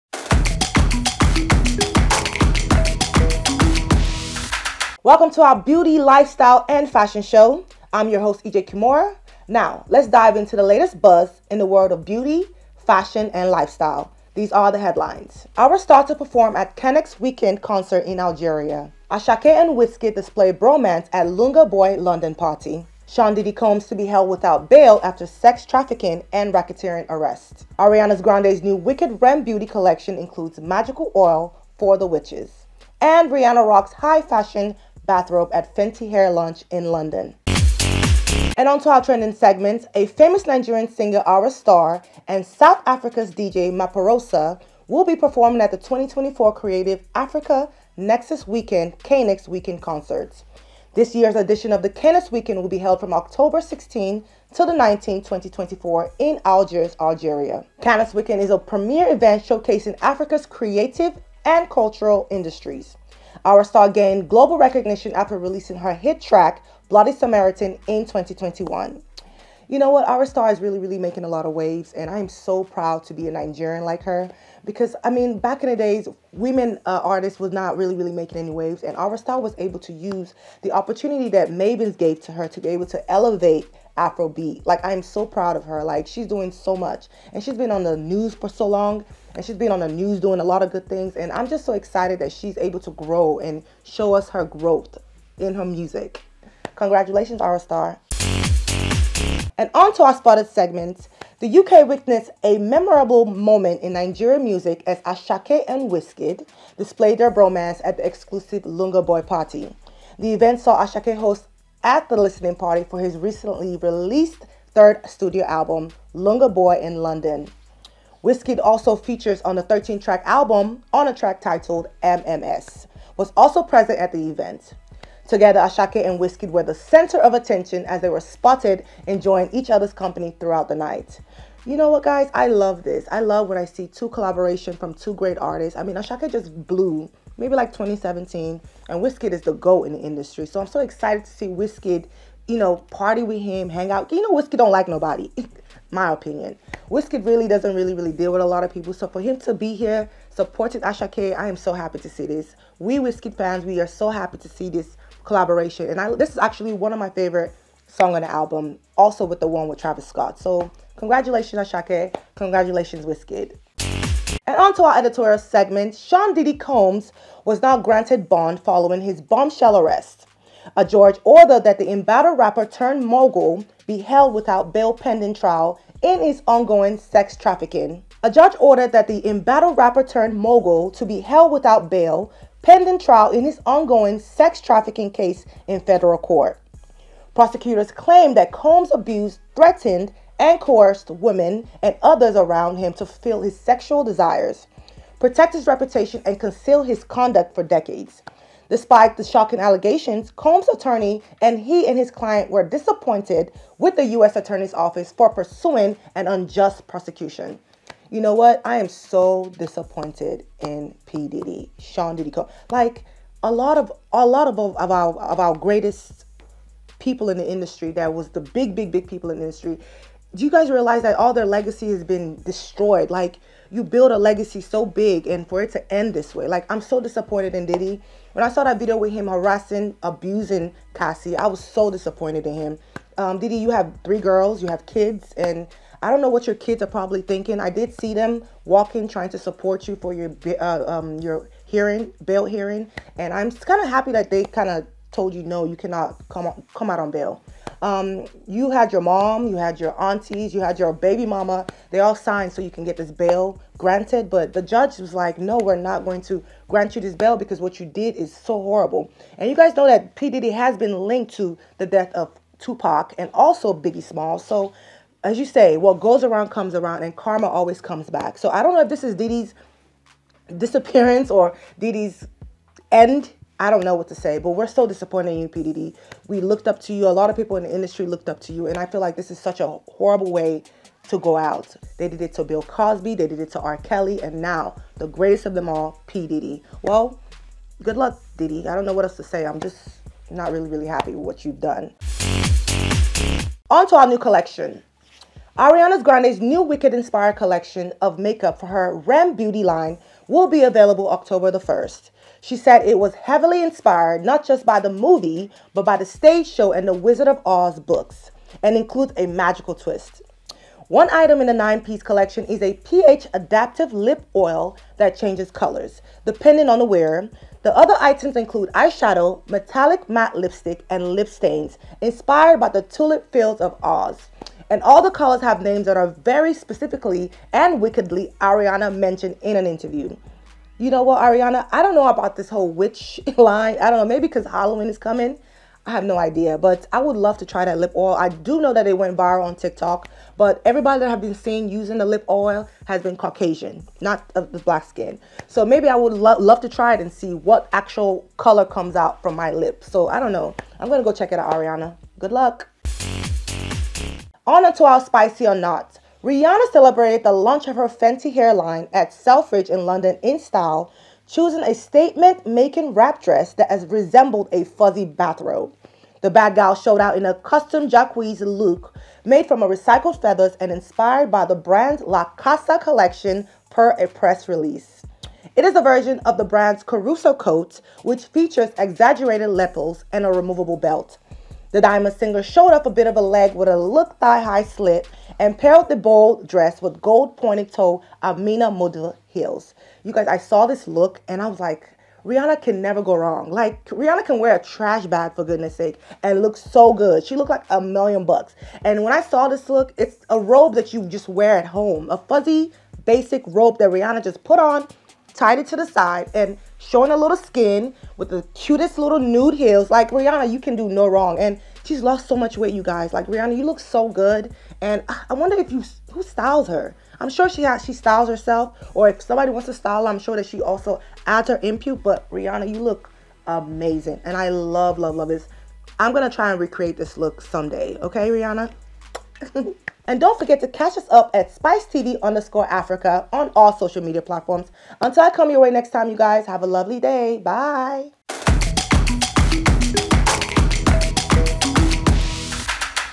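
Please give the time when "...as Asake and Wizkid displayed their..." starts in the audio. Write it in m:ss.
1:44.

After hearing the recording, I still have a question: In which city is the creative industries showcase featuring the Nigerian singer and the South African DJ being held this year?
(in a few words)
Algiers.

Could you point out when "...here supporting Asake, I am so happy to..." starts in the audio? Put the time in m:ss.
2:29.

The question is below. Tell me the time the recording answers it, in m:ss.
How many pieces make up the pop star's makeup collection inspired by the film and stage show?
5:11.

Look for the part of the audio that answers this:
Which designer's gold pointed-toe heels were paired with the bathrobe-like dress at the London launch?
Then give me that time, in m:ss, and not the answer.
6:28.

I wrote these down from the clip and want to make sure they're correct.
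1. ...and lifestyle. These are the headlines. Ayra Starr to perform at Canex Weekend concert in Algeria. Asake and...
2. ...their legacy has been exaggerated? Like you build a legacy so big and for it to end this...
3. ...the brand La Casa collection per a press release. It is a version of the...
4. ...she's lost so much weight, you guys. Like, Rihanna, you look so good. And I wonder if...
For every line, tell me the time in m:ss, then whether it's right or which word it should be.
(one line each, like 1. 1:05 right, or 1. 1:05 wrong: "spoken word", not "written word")
1. 0:13 right
2. 3:41 wrong: "destroyed", not "exaggerated"
3. 6:11 right
4. 6:51 right.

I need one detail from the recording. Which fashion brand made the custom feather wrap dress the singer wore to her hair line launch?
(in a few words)
Jacquemus.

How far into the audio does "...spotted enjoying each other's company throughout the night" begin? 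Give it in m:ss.
2:08.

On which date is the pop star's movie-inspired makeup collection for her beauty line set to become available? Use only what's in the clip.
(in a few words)
October 1st.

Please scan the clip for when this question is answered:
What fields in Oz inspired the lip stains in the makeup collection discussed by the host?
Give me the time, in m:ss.
5:22.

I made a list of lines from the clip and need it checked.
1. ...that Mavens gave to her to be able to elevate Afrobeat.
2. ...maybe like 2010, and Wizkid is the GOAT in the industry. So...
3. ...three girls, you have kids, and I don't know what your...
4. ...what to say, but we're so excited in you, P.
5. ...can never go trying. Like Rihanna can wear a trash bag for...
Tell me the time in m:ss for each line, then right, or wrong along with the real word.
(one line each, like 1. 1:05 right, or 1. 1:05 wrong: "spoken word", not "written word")
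1. 1:21 right
2. 2:17 wrong: "2017", not "2010"
3. 3:54 right
4. 4:33 wrong: "disappointed", not "excited"
5. 6:32 wrong: "wrong", not "trying".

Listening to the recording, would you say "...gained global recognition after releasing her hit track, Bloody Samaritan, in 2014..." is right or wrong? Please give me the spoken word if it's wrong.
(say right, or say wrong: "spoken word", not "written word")
wrong: "2021", not "2014".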